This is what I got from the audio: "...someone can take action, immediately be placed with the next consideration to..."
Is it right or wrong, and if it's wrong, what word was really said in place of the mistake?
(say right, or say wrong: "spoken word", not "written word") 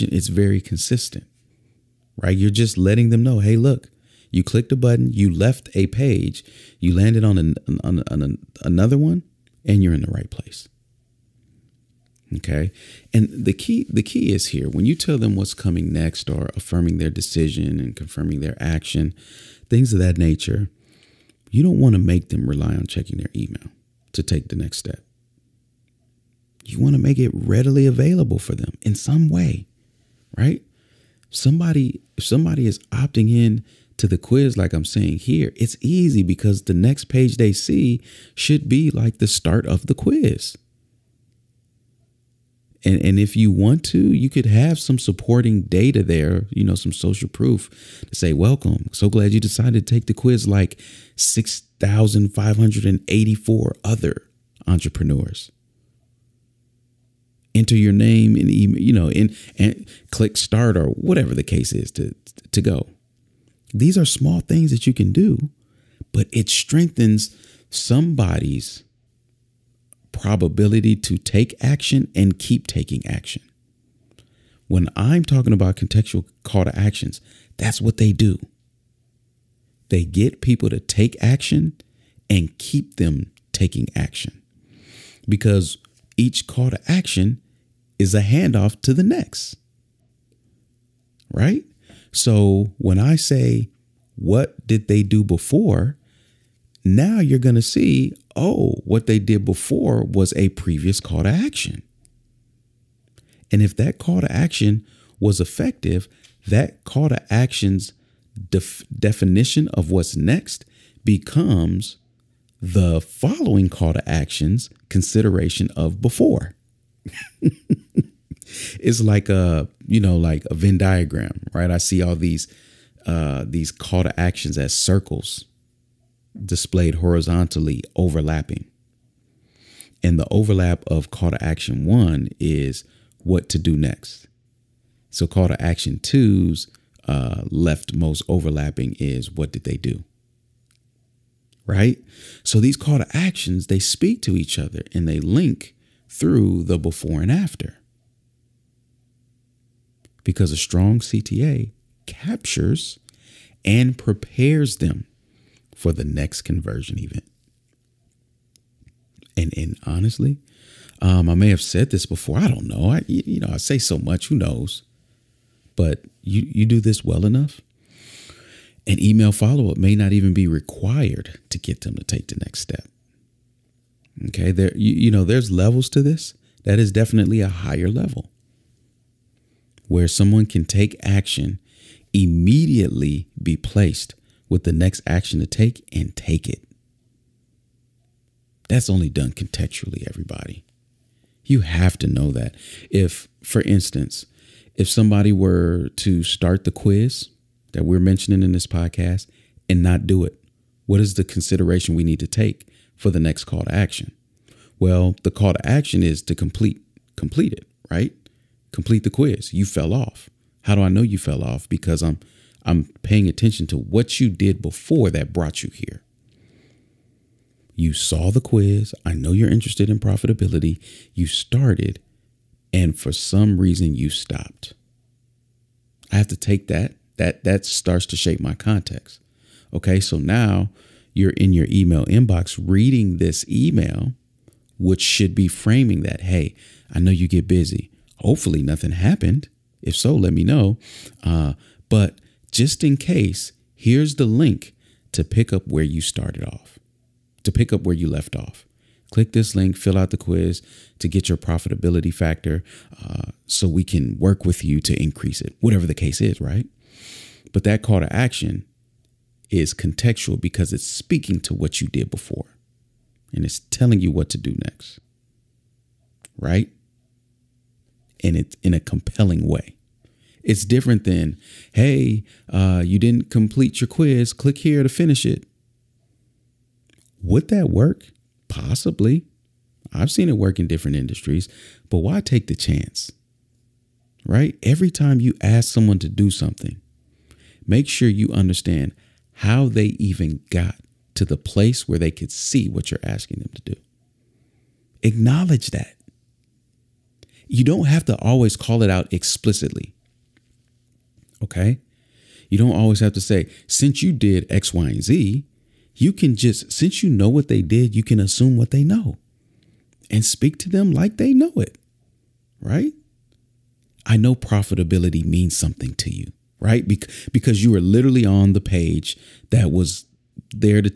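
wrong: "action", not "consideration".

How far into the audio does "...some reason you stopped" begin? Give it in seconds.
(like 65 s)
223 s.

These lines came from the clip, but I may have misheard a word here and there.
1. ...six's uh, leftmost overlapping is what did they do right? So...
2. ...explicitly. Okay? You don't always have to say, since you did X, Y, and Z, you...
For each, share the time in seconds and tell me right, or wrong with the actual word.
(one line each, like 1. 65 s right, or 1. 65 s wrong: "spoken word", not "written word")
1. 135 s wrong: "two", not "six"
2. 299 s right.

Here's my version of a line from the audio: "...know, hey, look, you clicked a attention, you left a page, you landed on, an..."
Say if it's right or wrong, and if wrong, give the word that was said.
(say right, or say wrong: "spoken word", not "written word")
wrong: "button", not "attention".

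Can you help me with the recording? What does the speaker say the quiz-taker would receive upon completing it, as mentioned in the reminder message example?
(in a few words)
profitability factor.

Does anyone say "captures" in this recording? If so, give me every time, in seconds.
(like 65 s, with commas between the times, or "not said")
152 s.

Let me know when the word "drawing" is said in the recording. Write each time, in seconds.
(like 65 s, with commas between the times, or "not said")
not said.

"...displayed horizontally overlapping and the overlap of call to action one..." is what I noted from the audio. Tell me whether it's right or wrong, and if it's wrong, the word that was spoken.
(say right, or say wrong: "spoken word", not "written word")
right.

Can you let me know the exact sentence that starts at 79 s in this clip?
They get people to take action and keep them taking action because each call to action is a handoff to the next.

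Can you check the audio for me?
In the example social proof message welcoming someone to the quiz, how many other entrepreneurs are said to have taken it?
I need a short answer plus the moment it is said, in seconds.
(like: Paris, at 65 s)
6,584, at 51 s.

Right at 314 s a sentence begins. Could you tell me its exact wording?
I know profitability means something to you, right?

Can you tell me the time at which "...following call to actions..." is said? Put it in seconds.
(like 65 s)
113 s.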